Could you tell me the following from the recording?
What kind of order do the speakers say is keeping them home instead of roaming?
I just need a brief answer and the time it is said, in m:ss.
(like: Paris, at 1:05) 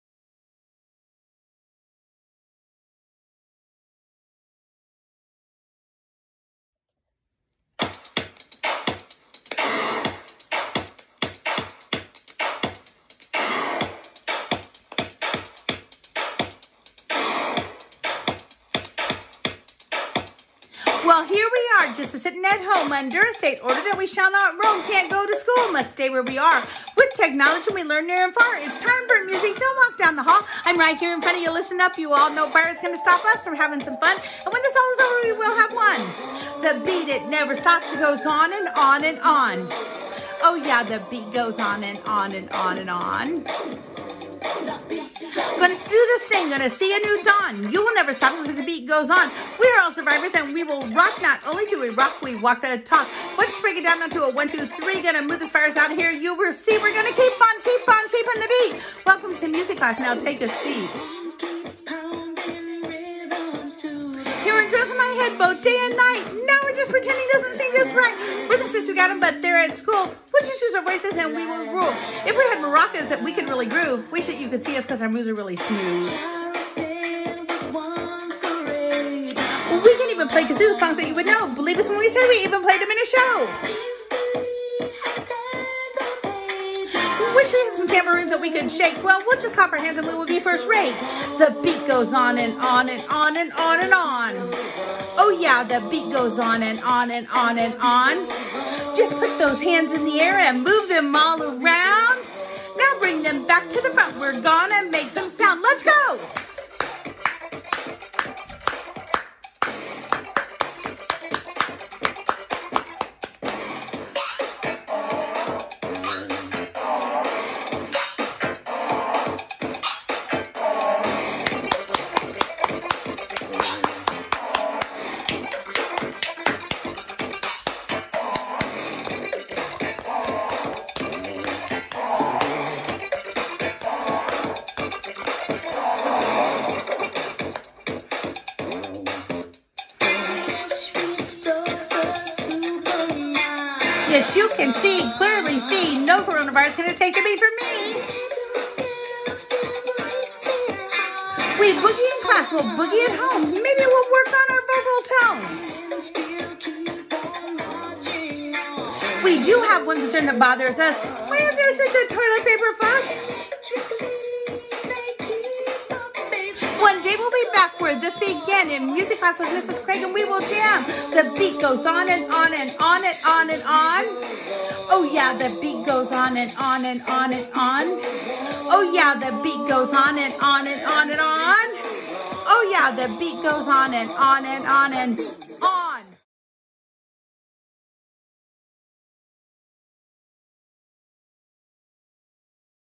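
State order, at 0:23.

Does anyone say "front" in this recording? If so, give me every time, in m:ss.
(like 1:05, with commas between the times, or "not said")
0:31, 1:43.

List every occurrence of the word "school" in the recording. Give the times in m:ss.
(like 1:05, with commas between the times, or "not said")
0:25, 1:09.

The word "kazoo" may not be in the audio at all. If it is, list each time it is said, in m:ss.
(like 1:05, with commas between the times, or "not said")
1:20.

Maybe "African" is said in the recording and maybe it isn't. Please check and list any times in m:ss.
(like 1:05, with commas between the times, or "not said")
not said.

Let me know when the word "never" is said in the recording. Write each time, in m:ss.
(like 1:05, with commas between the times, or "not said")
0:37, 0:47.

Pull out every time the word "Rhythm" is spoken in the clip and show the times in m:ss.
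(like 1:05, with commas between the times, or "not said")
1:08.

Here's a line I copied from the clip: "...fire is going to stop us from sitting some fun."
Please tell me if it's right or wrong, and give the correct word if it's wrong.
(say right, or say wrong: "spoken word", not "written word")
wrong: "having", not "sitting".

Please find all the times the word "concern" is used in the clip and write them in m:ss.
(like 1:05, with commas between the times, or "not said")
2:40.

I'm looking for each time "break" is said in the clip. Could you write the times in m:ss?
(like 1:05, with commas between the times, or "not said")
0:53.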